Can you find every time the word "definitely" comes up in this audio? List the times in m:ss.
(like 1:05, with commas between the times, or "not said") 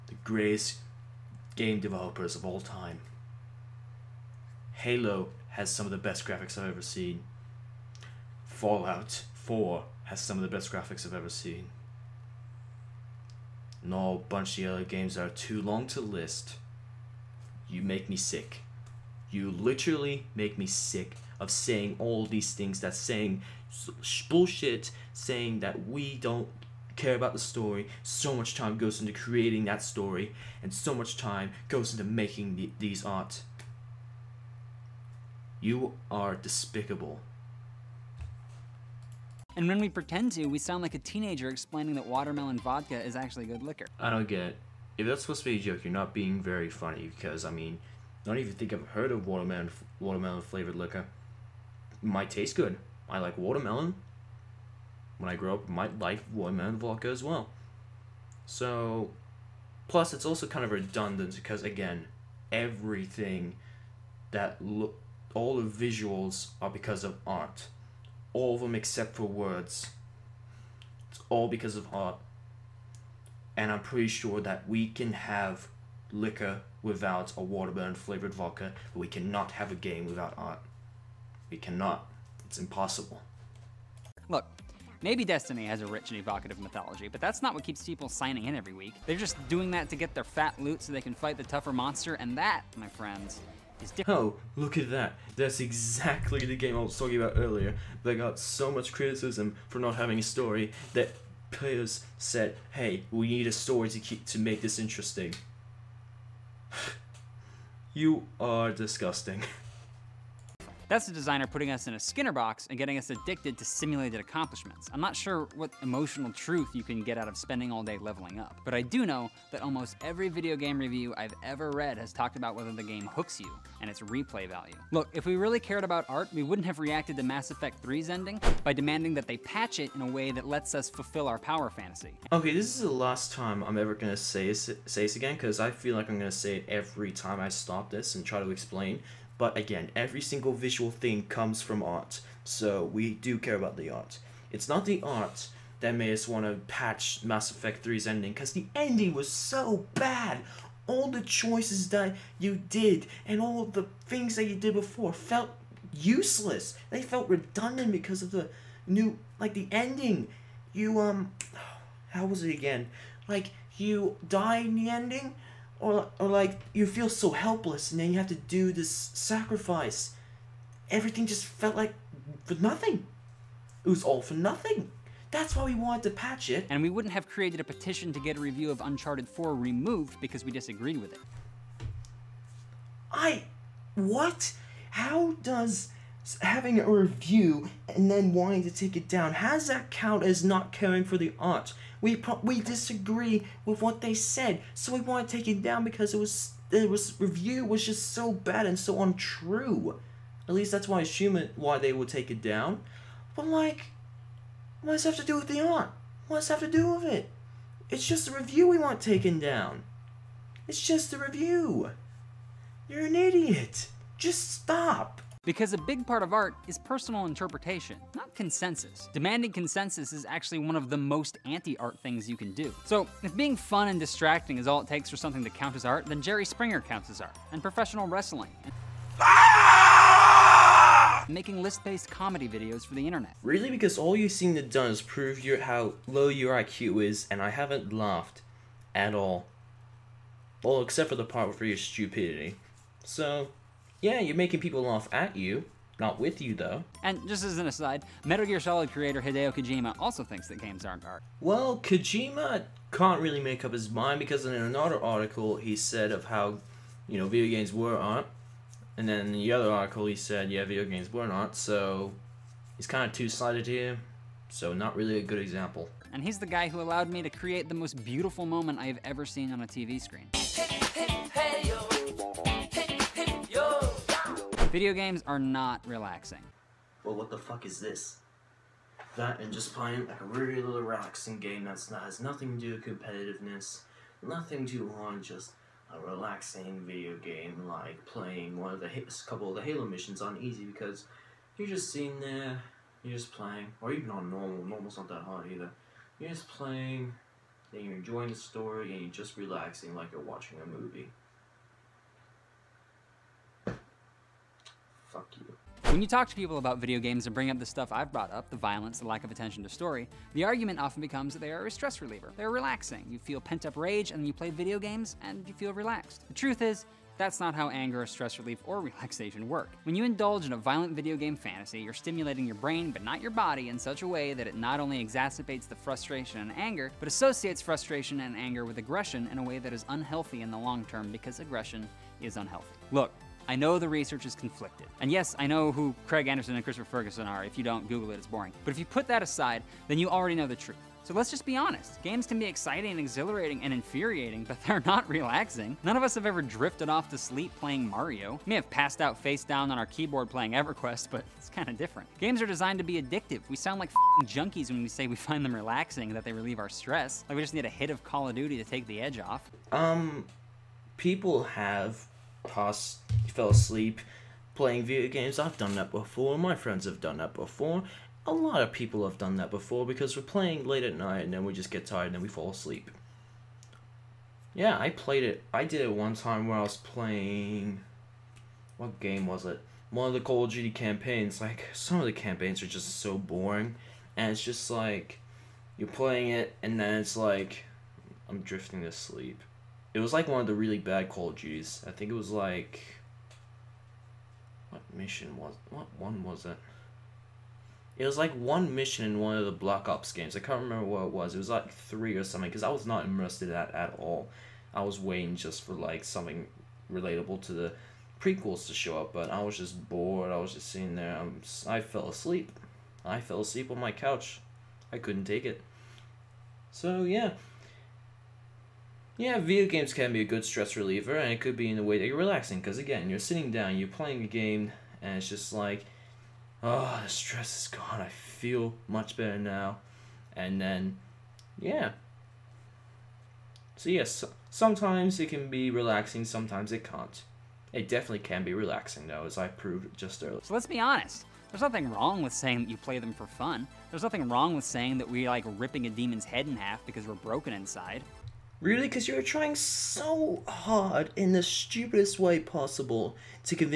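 7:17.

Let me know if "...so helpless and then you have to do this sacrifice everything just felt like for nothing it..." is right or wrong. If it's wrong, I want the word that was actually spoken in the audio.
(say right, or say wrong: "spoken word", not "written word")
right.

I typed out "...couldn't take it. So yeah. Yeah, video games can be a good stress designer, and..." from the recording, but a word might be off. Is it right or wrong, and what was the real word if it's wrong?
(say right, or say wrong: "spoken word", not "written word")
wrong: "reliever", not "designer".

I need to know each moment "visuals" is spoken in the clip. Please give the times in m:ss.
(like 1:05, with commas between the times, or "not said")
1:05, 2:20.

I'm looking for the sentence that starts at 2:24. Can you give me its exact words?
It's not the art that made us want to patch Mass Effect 3's ending, because the ending was so bad!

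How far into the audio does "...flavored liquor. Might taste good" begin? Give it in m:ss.
0:50.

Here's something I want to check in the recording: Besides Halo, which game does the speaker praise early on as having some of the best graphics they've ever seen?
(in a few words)
Fallout 4.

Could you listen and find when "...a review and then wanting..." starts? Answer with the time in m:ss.
3:06.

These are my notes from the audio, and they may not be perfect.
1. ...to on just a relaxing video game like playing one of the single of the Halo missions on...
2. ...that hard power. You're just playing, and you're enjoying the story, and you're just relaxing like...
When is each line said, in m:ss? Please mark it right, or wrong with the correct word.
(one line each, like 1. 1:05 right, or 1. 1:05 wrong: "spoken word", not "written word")
1. 4:44 wrong: "couple", not "single"
2. 4:55 wrong: "either", not "power".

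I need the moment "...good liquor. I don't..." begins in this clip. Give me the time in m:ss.
0:43.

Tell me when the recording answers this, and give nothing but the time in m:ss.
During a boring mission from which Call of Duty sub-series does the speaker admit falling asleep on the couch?
6:39.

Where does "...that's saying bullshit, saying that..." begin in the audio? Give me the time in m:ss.
0:22.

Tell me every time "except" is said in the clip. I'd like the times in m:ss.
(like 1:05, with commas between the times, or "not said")
1:08, 4:00.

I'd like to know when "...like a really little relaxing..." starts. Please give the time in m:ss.
4:40.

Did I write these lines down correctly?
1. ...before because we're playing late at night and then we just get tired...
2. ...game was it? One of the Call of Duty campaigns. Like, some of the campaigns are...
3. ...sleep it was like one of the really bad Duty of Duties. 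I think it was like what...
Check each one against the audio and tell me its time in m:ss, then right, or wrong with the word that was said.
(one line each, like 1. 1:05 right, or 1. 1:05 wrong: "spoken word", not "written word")
1. 6:09 right
2. 6:18 right
3. 6:28 wrong: "Call", not "Duty".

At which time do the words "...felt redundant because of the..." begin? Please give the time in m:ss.
2:37.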